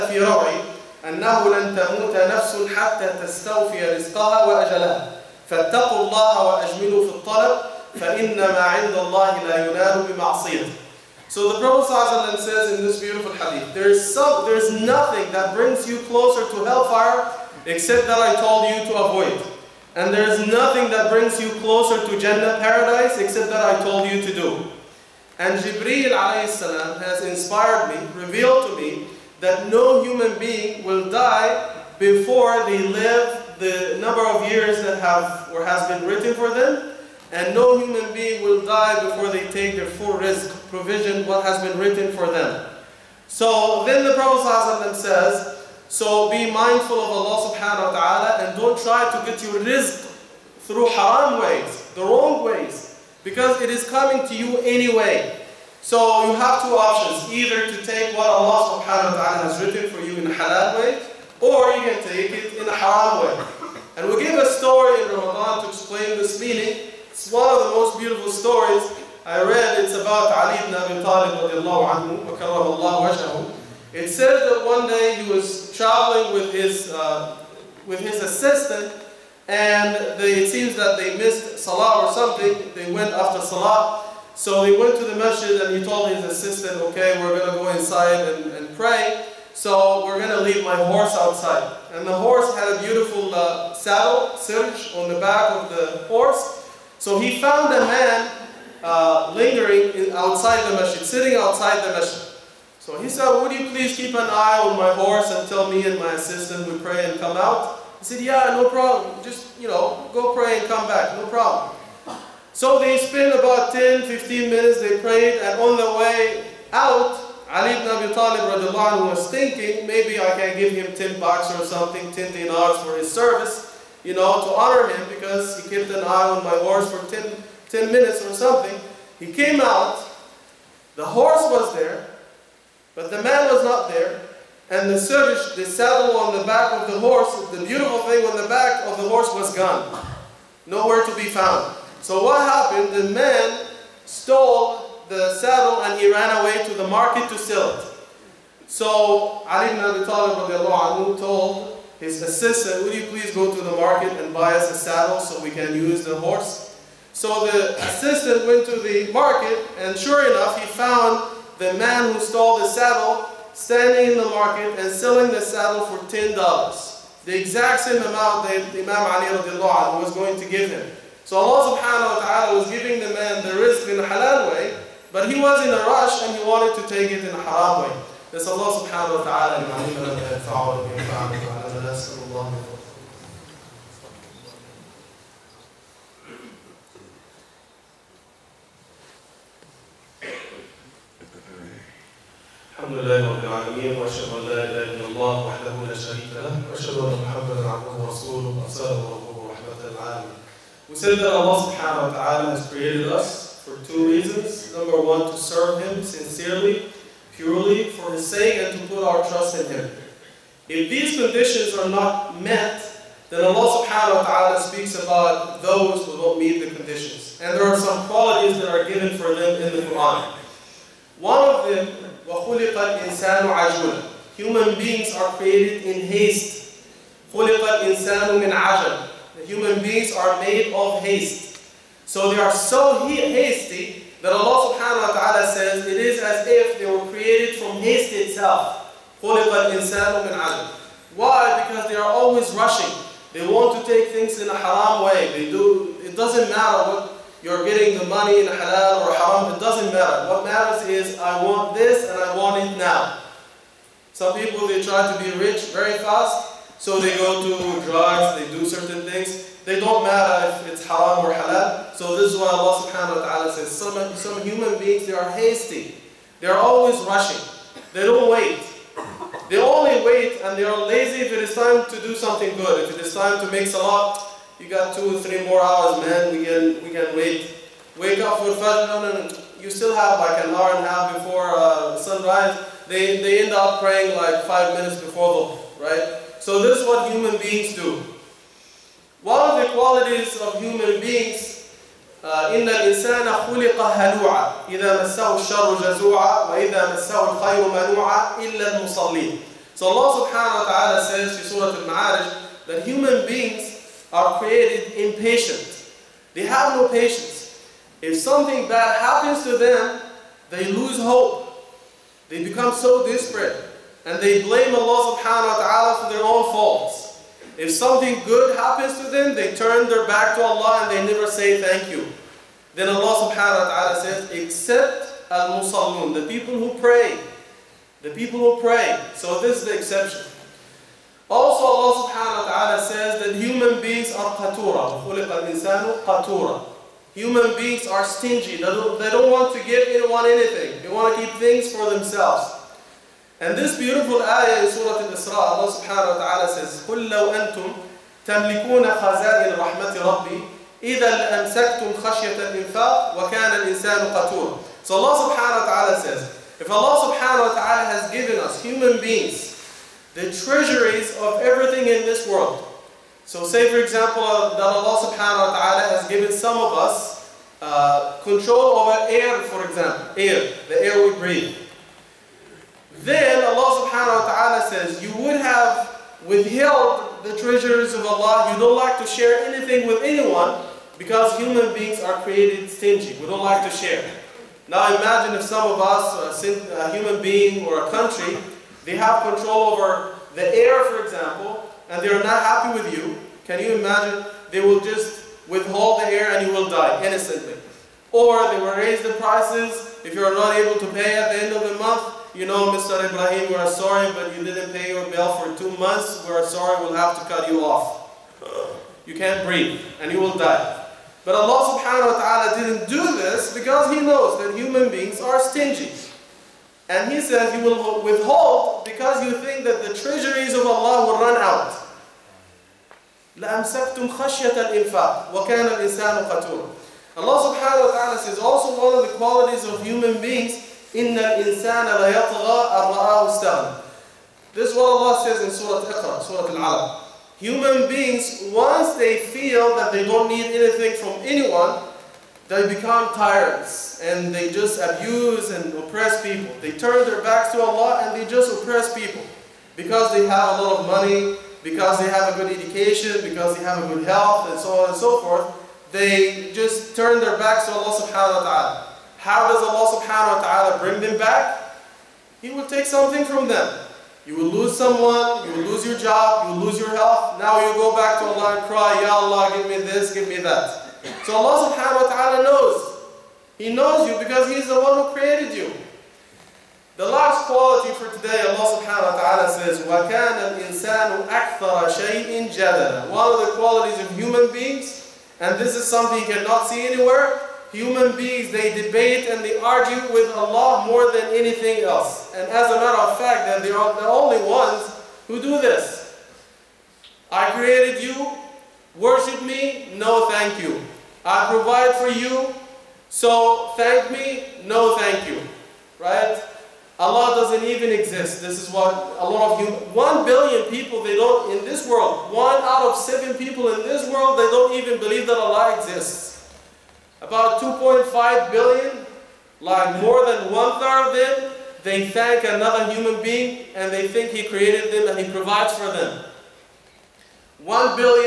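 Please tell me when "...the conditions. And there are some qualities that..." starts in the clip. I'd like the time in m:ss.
3:36.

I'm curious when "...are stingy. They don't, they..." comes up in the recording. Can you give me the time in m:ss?
5:37.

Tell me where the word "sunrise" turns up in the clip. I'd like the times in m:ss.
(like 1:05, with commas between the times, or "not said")
4:41.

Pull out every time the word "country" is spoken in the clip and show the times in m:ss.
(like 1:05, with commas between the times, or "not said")
6:27.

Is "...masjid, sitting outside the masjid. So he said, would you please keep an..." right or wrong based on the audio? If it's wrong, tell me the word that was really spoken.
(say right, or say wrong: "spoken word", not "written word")
right.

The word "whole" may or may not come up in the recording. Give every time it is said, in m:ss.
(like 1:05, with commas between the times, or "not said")
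not said.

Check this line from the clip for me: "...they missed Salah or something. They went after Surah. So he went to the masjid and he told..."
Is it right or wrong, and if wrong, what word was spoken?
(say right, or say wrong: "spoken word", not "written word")
wrong: "Salah", not "Surah".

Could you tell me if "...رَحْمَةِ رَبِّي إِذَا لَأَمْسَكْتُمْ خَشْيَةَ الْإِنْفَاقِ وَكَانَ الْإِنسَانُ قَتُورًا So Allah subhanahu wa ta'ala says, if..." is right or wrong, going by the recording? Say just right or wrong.
right.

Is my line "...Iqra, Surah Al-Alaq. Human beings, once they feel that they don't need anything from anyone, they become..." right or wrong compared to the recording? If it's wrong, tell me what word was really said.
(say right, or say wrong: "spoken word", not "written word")
right.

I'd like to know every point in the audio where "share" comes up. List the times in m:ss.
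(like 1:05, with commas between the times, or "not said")
6:19, 6:23.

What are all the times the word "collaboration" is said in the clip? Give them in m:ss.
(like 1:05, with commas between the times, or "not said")
not said.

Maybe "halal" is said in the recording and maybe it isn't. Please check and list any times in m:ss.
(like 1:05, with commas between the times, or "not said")
1:00, 2:54, 4:08, 4:21.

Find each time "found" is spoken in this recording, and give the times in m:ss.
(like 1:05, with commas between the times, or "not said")
1:37, 2:21, 2:40.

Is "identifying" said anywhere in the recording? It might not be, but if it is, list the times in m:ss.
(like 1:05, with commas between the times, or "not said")
not said.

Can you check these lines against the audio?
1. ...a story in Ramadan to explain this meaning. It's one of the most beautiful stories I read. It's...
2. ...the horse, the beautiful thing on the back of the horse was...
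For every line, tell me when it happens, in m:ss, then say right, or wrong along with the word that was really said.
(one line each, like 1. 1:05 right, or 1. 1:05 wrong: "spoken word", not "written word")
1. 1:04 right
2. 2:16 right.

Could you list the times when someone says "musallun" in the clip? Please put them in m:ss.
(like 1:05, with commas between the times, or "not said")
5:25.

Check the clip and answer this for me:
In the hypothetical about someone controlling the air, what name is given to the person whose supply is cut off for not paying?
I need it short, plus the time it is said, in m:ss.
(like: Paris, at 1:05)
Mr. Ibrahim, at 6:42.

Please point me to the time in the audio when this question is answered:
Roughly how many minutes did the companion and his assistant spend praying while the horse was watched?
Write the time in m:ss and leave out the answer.
1:53.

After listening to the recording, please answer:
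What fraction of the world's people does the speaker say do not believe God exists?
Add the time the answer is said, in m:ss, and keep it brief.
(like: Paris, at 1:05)
one out of seven, at 8:32.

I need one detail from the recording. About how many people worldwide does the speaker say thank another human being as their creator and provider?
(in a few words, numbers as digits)
2.5 billion.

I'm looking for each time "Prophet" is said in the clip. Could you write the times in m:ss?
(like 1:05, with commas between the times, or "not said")
0:11, 0:44.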